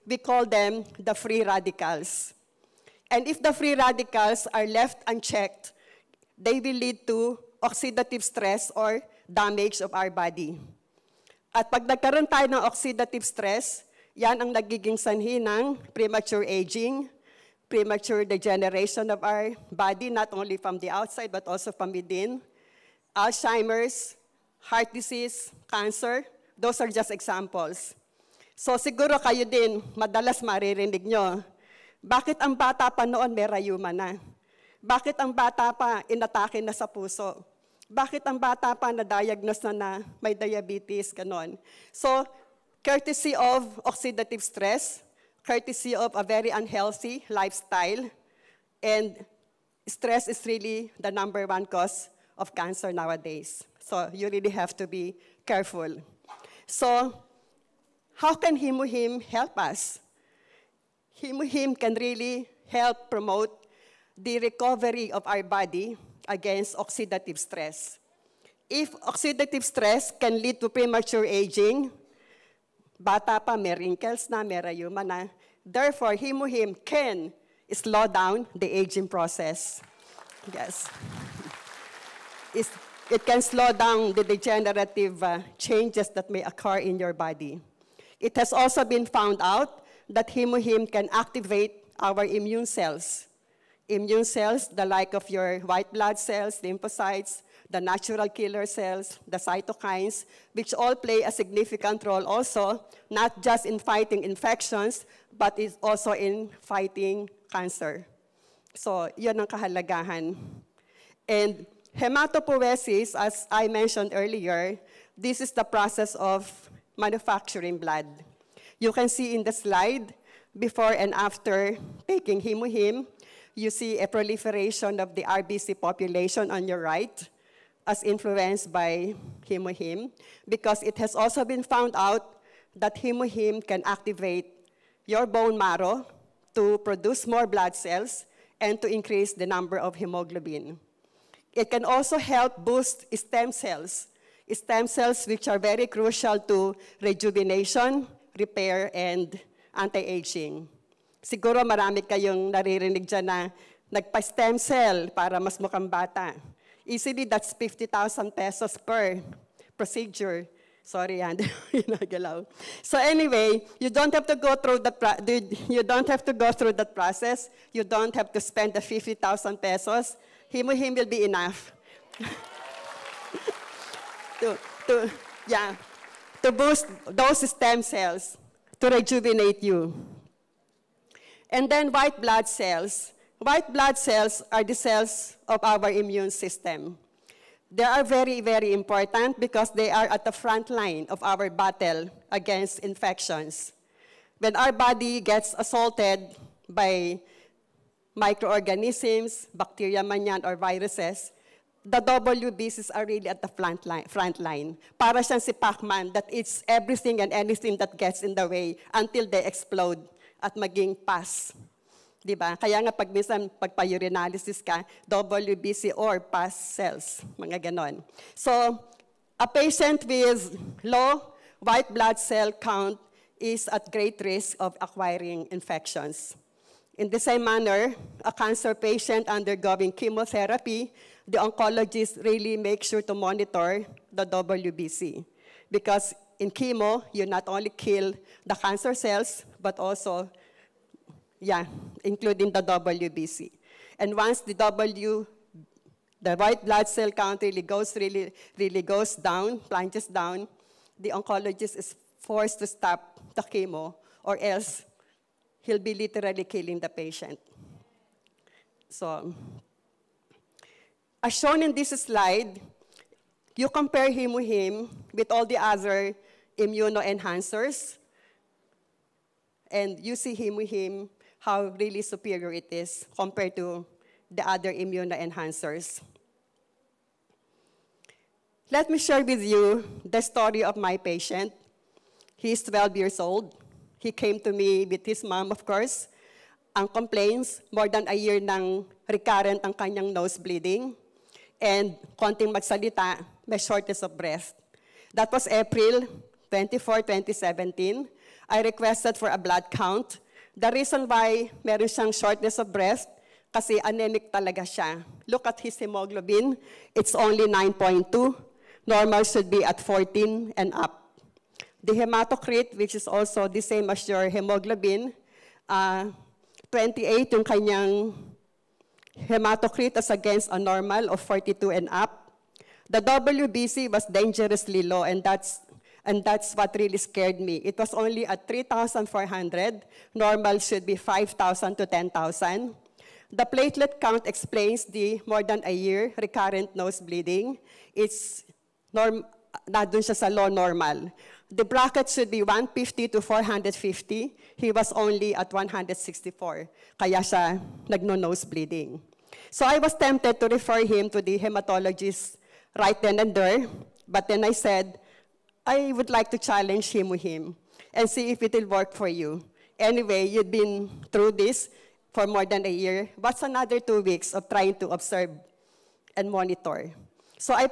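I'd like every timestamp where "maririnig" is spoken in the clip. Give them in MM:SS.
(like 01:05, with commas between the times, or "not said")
00:30.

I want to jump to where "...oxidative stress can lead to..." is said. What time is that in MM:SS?
01:09.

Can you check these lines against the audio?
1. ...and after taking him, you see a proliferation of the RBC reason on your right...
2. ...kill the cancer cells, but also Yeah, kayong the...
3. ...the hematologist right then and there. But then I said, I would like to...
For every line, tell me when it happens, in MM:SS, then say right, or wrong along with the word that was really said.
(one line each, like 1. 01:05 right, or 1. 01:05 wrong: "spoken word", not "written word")
1. 02:00 wrong: "population", not "reason"
2. 03:57 wrong: "including", not "kayong"
3. 05:51 right.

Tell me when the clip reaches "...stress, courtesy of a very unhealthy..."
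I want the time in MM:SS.
00:44.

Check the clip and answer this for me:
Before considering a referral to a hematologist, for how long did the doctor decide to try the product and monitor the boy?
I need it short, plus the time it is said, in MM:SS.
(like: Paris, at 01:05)
2 weeks, at 06:03.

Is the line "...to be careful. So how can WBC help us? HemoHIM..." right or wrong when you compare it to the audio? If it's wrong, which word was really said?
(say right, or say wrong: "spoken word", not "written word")
wrong: "HemoHIM", not "WBC".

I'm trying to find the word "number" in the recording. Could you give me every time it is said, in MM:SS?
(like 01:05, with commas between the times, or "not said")
00:51, 02:19.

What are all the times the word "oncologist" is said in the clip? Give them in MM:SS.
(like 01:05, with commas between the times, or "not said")
03:51, 04:11.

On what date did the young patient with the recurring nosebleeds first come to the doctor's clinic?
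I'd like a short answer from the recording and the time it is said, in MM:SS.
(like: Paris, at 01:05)
April 24, 2017, at 04:55.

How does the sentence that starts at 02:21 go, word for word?
It can also help boost stem cells, stem cells which are very crucial to rejuvenation, repair, and anti-aging.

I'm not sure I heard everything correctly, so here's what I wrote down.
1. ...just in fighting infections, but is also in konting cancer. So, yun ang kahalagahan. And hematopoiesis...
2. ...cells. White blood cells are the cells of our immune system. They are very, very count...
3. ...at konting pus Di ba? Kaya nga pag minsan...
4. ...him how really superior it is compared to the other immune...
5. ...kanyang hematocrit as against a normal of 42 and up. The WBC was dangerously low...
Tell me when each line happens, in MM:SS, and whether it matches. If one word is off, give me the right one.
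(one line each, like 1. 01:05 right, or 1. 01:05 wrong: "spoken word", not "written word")
1. 01:43 wrong: "fighting", not "konting"
2. 03:02 wrong: "important", not "count"
3. 03:30 wrong: "maging", not "konting"
4. 04:30 right
5. 05:17 right.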